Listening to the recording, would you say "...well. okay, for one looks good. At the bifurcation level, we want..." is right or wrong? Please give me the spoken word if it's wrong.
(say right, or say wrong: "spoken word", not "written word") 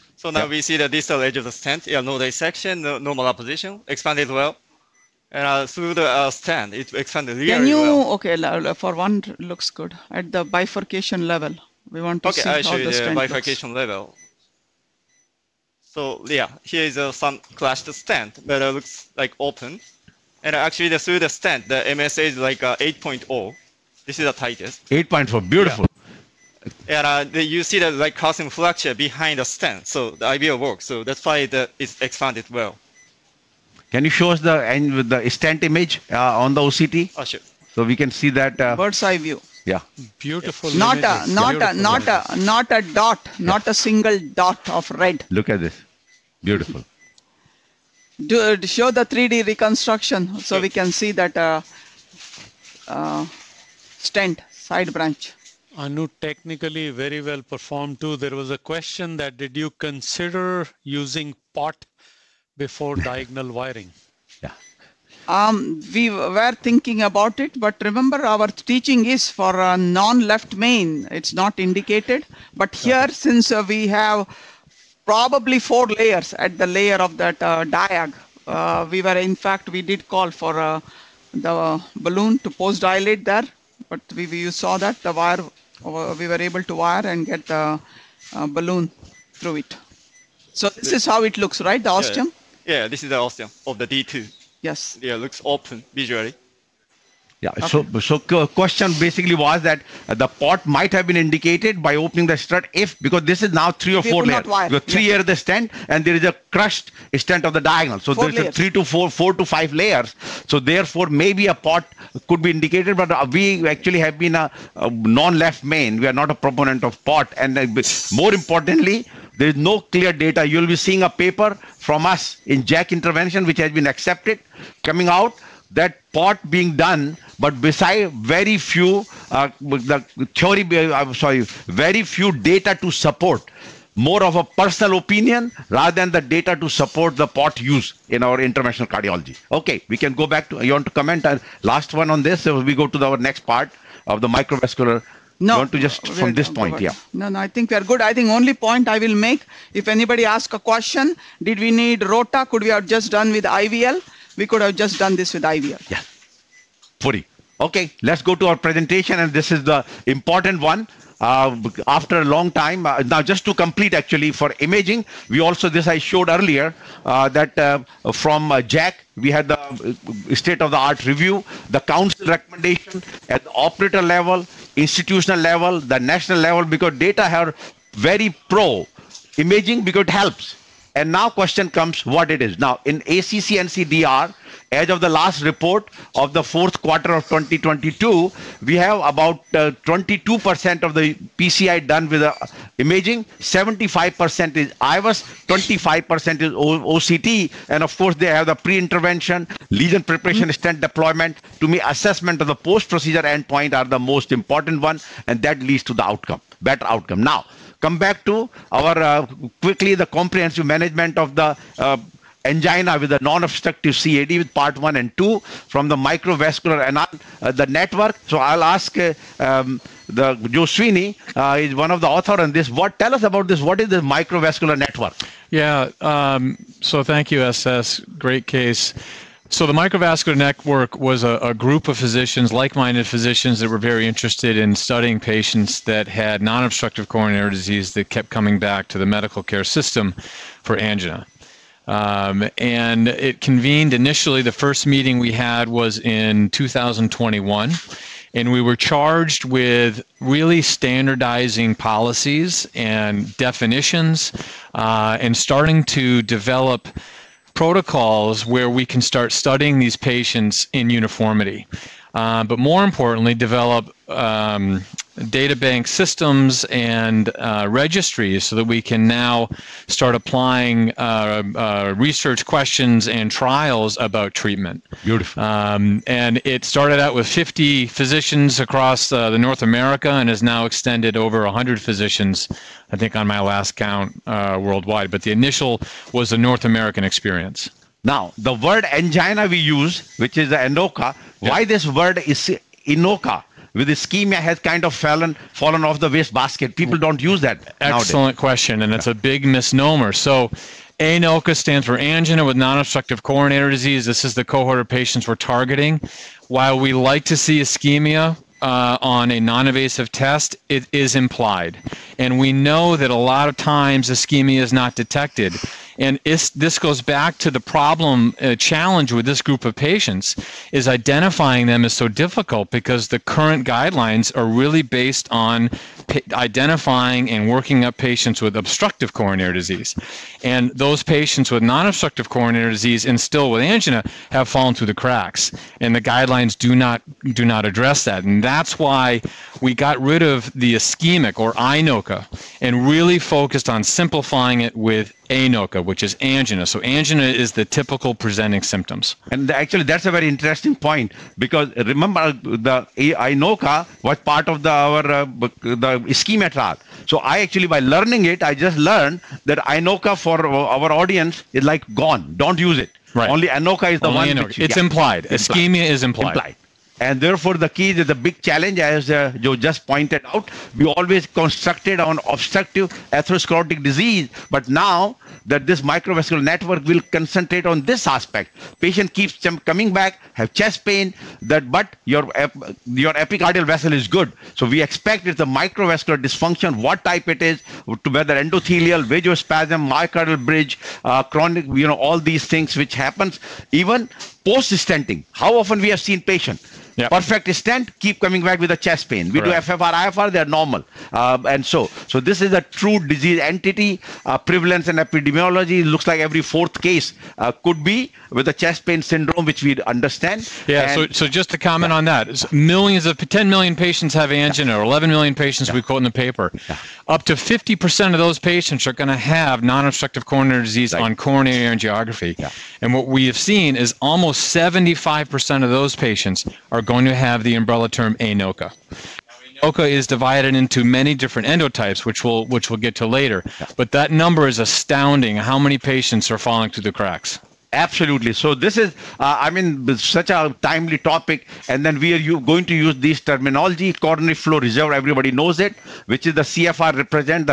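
right.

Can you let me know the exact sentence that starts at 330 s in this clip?
And those patients with non-obstructive coronary disease and still with angina have fallen through the cracks.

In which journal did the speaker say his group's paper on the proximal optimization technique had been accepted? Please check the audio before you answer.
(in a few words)
JACC Intervention.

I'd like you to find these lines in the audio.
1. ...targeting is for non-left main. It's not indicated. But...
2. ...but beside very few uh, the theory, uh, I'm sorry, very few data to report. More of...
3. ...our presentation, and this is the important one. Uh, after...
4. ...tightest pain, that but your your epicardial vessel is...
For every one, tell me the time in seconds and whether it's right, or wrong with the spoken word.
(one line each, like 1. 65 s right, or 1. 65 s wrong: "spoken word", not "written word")
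1. 68 s wrong: "teaching", not "targeting"
2. 127 s wrong: "support", not "report"
3. 158 s right
4. 380 s wrong: "chest", not "tightest".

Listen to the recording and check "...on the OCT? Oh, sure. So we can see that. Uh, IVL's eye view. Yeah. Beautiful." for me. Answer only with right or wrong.
wrong.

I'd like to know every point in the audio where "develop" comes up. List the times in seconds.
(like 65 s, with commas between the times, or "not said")
256 s, 263 s.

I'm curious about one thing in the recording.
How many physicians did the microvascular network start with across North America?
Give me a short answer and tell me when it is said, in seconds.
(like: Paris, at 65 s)
50, at 277 s.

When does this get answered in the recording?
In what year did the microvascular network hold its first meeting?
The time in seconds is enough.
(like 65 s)
246 s.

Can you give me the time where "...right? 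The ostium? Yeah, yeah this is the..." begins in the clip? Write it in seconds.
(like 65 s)
91 s.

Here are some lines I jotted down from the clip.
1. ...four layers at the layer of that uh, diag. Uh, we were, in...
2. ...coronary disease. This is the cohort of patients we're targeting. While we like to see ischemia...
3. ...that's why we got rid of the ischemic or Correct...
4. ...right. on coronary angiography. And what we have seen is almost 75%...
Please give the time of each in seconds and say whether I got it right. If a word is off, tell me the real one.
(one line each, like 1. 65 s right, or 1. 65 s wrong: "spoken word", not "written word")
1. 75 s right
2. 303 s right
3. 338 s wrong: "INOCA", not "Correct"
4. 420 s right.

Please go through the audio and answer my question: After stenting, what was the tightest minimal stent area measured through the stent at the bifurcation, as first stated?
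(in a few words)
8.0.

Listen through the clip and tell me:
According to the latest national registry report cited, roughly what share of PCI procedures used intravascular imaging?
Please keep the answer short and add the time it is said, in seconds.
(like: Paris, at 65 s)
22%, at 189 s.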